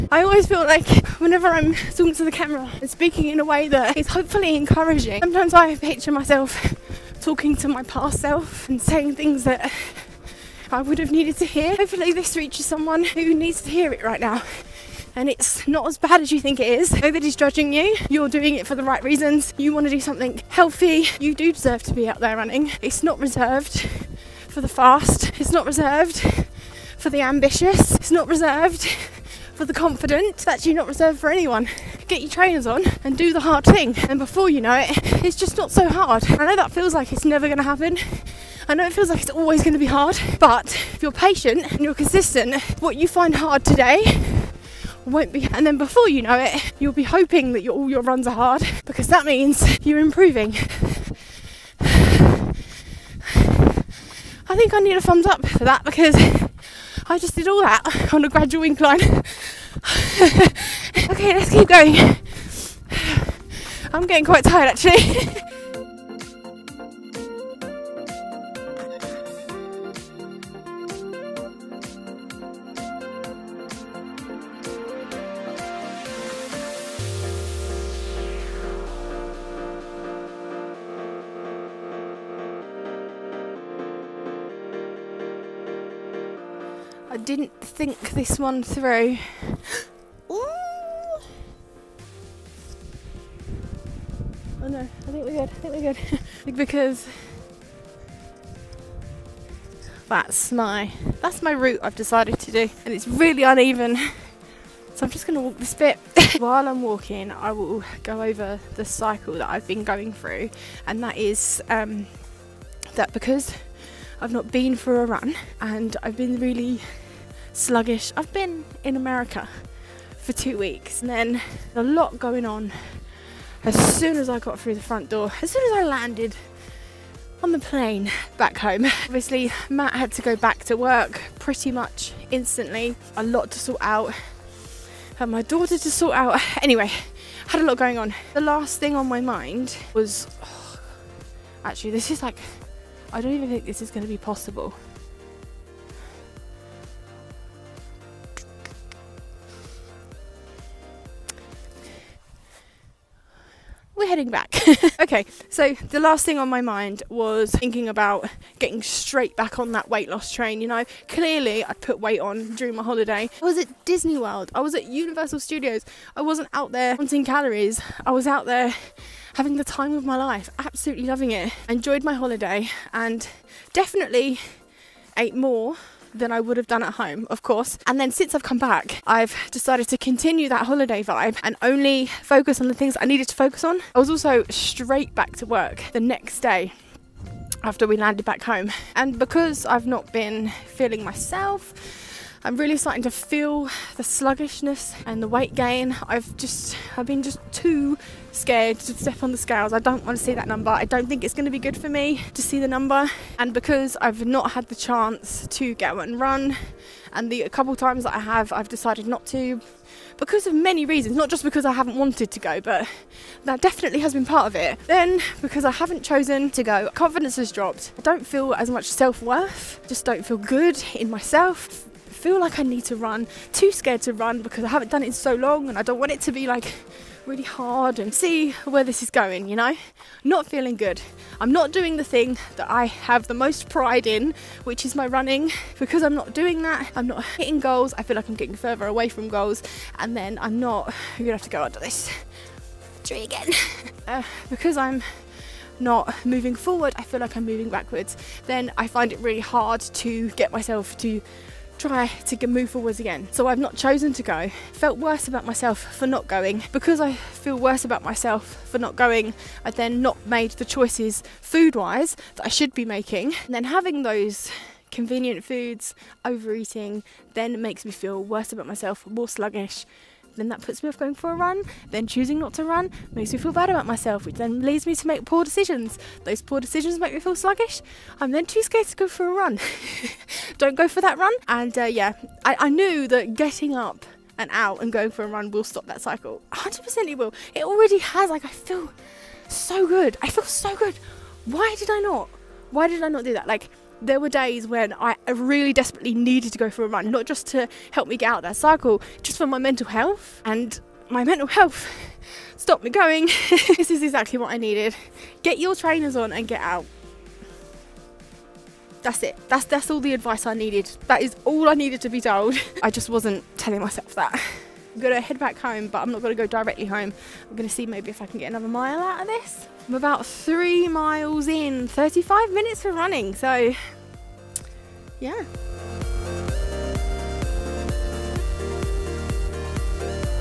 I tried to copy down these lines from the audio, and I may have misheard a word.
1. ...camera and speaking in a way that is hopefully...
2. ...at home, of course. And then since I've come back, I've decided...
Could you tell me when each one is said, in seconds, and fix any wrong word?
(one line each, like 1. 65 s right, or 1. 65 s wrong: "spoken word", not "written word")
1. 2 s right
2. 176 s right.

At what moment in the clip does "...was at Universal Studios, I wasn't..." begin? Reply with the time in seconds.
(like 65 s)
164 s.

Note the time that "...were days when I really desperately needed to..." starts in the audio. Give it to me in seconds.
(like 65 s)
294 s.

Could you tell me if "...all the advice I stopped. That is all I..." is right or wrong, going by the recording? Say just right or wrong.
wrong.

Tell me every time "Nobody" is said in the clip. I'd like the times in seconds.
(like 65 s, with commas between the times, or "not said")
17 s.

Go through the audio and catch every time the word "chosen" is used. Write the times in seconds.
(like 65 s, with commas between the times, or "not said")
216 s, 253 s.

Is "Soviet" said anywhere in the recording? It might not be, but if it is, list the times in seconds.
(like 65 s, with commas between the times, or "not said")
not said.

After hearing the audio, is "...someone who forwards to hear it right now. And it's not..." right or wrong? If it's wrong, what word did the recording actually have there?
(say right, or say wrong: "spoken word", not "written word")
wrong: "needs", not "forwards".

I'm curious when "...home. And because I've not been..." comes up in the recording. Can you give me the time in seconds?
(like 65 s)
188 s.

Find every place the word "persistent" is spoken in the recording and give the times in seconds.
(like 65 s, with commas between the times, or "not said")
not said.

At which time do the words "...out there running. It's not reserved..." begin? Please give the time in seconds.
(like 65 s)
22 s.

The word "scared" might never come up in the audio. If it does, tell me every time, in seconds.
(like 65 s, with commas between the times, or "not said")
198 s, 223 s, 278 s.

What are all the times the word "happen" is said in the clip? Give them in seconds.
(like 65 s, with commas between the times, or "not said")
37 s.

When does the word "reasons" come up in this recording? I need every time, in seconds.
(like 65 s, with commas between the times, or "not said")
19 s, 210 s.